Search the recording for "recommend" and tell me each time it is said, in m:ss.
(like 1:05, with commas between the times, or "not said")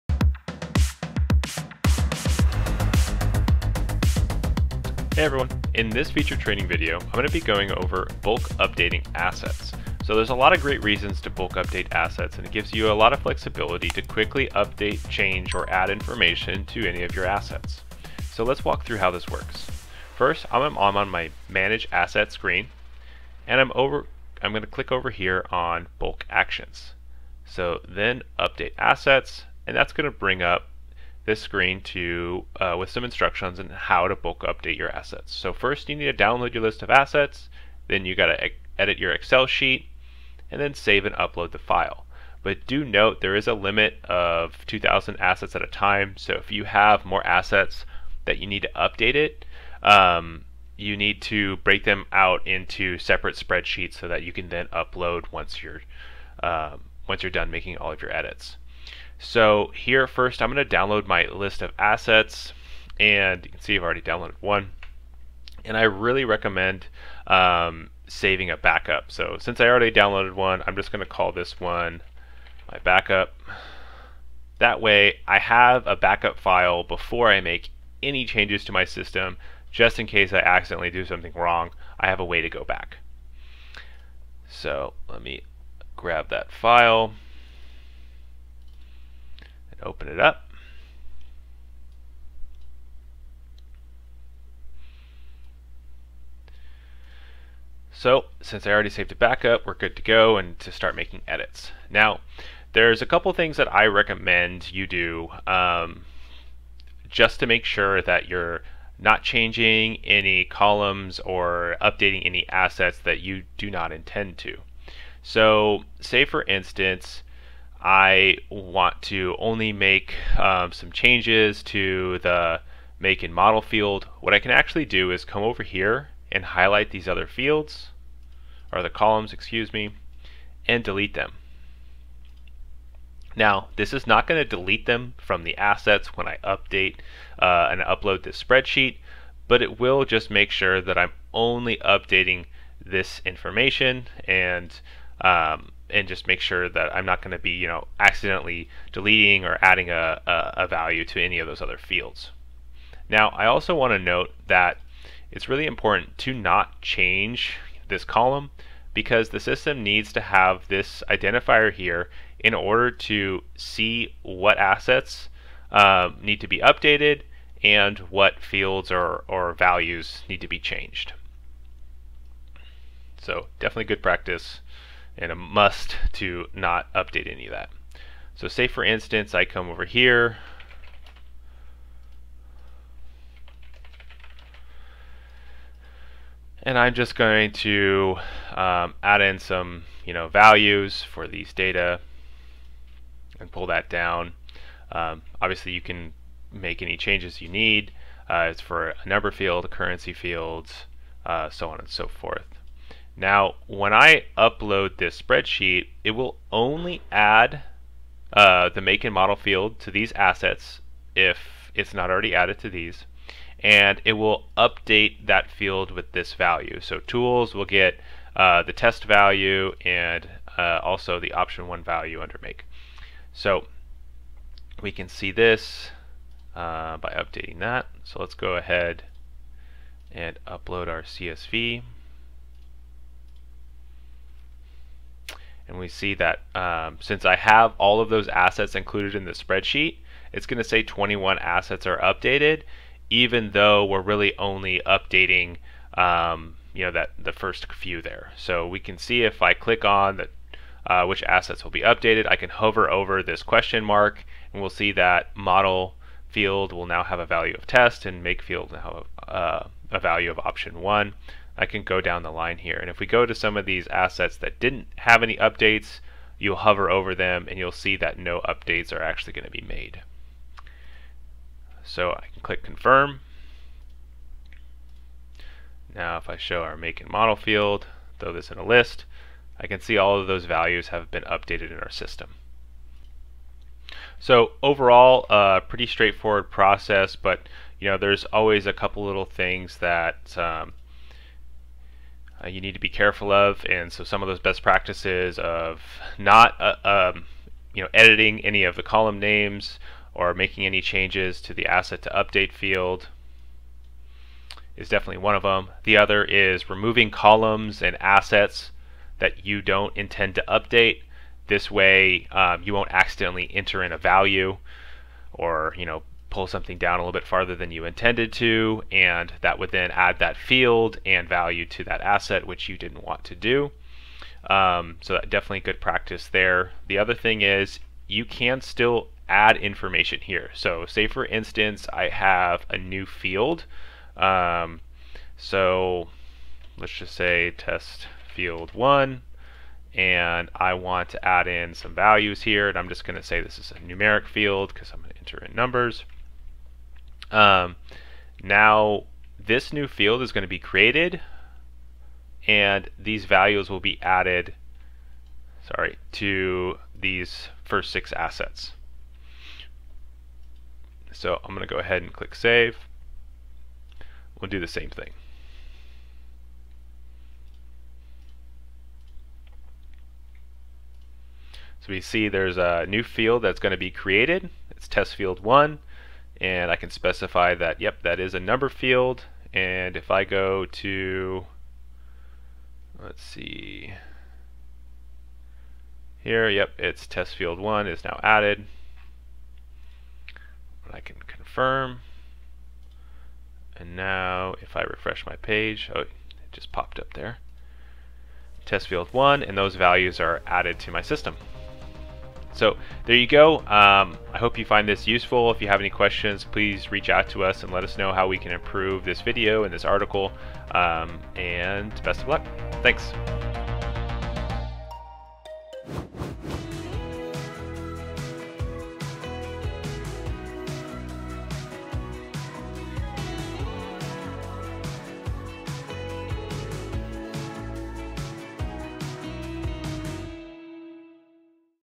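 1:06, 1:43.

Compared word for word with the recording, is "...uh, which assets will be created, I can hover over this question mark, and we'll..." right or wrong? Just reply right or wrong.
wrong.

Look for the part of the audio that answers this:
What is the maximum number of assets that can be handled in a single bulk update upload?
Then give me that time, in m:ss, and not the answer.
0:44.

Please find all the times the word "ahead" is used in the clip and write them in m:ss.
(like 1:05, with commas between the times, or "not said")
3:48, 6:01.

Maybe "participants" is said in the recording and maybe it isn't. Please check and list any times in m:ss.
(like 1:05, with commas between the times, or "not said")
not said.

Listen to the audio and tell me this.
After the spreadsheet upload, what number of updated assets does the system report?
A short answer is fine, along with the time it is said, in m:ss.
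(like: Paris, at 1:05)
21, at 4:00.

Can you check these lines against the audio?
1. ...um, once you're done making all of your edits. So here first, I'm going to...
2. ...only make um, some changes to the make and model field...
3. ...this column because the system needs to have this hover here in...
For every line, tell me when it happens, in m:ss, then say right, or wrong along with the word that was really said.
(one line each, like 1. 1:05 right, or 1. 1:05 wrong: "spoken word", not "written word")
1. 0:56 right
2. 1:59 right
3. 2:37 wrong: "identifier", not "hover".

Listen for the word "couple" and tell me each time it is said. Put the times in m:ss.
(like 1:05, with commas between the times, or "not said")
1:43, 4:48.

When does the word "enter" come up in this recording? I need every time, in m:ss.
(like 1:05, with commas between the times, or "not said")
5:13, 5:45.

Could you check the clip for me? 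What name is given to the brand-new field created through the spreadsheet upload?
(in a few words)
test field one.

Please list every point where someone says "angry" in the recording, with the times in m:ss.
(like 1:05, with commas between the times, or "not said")
not said.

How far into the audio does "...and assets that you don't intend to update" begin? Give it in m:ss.
5:07.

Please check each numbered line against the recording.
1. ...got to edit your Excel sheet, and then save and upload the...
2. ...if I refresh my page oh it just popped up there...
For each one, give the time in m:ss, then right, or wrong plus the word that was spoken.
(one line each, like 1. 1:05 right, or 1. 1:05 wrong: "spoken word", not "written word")
1. 0:38 right
2. 6:34 right.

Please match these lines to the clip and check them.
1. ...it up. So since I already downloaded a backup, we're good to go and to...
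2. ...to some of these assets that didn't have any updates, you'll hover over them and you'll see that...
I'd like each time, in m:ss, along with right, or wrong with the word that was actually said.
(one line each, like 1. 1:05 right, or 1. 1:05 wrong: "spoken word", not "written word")
1. 1:30 wrong: "saved", not "downloaded"
2. 4:23 right.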